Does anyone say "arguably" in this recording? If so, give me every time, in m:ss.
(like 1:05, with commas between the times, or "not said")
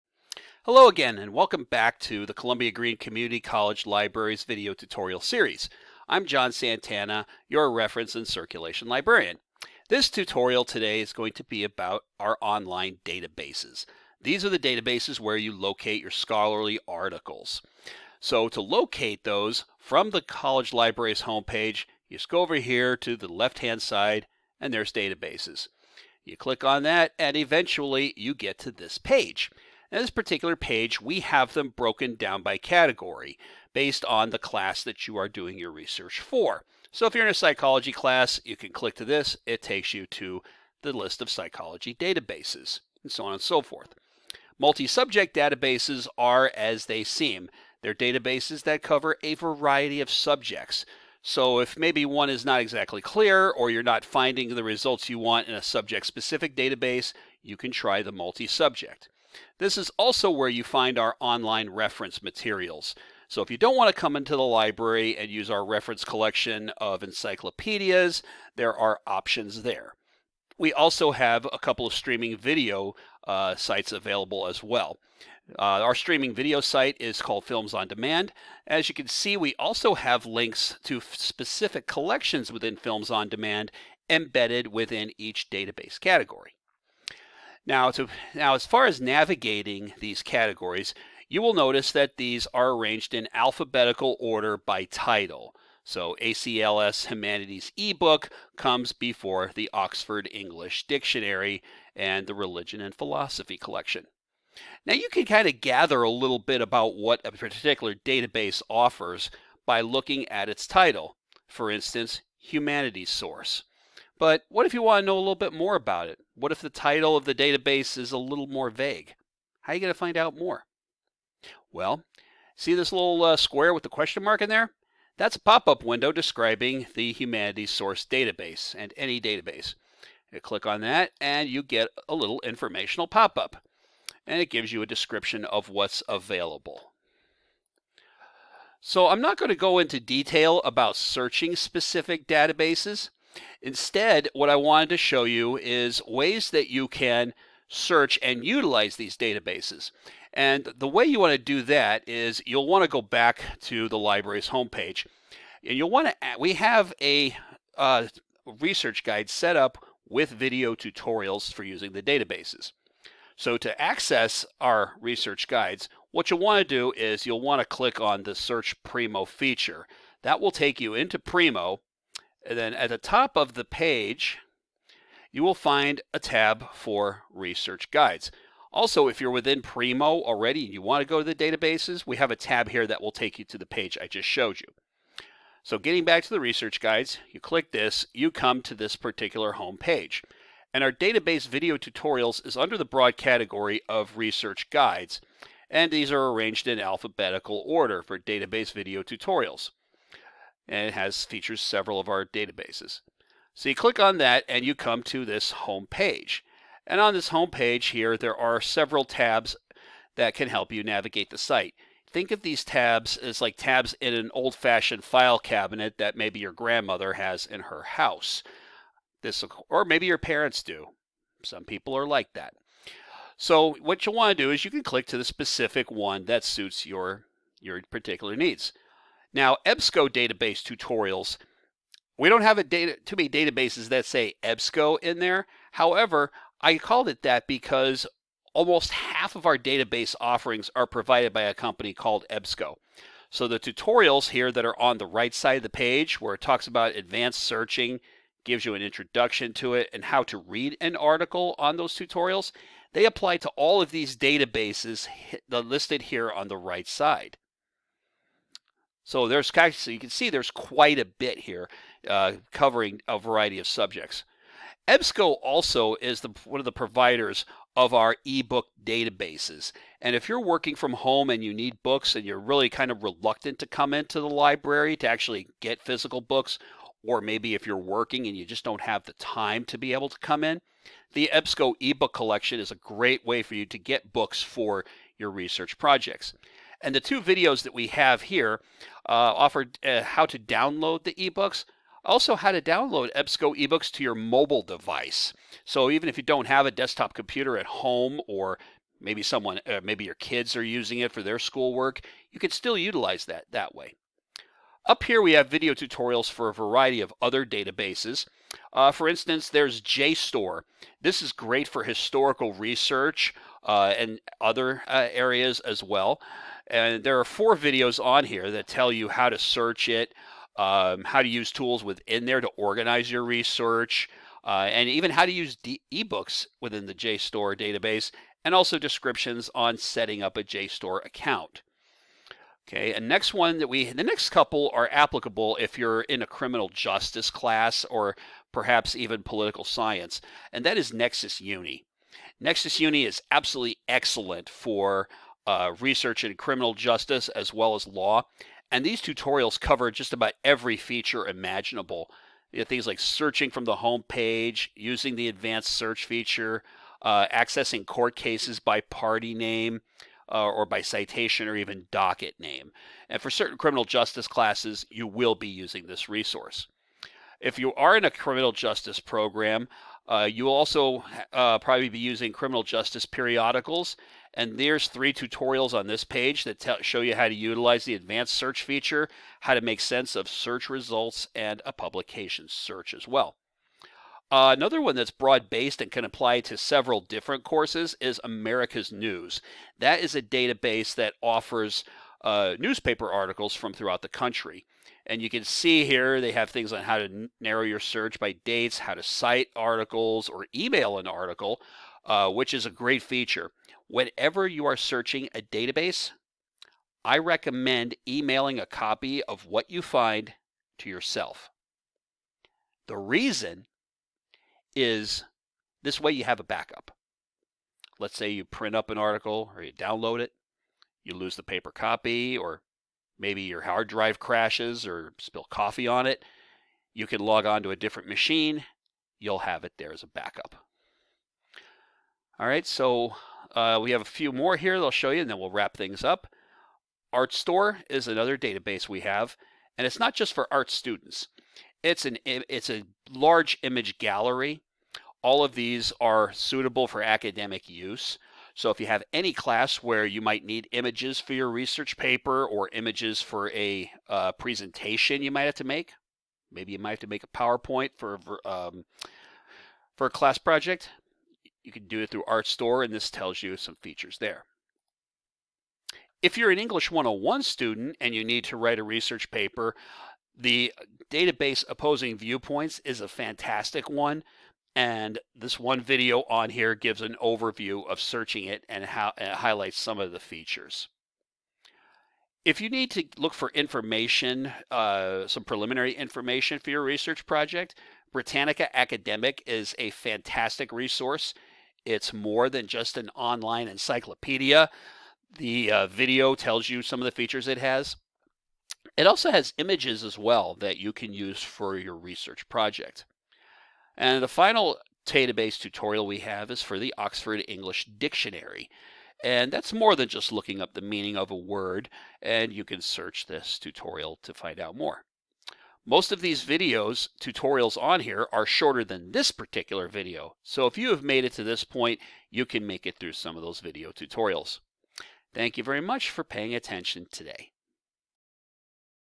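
not said.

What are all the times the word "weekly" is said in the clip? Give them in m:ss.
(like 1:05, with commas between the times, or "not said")
not said.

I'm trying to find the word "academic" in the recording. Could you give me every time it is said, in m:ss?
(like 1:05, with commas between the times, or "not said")
7:27, 8:08.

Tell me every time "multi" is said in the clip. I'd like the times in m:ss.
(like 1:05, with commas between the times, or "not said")
0:44, 0:58.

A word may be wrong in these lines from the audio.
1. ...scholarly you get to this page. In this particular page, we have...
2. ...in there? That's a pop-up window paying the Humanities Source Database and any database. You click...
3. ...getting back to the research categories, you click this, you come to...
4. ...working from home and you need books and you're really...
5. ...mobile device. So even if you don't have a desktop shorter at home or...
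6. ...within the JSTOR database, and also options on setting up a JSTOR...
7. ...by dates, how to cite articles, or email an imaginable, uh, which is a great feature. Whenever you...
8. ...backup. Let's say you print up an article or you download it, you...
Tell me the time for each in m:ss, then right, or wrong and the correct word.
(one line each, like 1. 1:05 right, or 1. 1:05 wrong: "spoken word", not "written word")
1. 0:27 wrong: "eventually", not "scholarly"
2. 2:04 wrong: "describing", not "paying"
3. 3:05 wrong: "guides", not "categories"
4. 4:30 right
5. 4:54 wrong: "computer", not "shorter"
6. 5:26 wrong: "descriptions", not "options"
7. 6:38 wrong: "article", not "imaginable"
8. 6:56 right.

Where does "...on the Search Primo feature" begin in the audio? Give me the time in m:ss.
2:48.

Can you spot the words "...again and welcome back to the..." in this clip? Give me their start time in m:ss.
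0:00.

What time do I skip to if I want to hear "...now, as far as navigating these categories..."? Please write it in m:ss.
1:28.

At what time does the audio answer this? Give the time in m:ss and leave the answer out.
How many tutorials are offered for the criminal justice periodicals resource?
6:14.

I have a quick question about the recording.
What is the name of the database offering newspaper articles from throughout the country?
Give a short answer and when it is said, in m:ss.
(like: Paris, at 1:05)
America's News, at 6:28.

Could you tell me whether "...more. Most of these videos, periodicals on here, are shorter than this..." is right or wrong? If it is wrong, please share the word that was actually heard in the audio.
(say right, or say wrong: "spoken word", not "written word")
wrong: "tutorials", not "periodicals".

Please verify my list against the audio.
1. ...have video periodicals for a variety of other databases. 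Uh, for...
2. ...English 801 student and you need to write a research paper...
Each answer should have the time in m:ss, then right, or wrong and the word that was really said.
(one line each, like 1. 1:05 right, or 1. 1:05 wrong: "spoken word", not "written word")
1. 5:05 wrong: "tutorials", not "periodicals"
2. 7:46 wrong: "101", not "801".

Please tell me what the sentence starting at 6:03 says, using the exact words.
And for certain criminal justice classes, you will be using this resource.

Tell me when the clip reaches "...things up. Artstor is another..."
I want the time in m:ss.
7:15.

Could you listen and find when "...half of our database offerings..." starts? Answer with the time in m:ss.
3:58.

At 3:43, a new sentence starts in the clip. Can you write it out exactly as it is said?
So what you want to do is you can click to the specific one that suits your your particular needs.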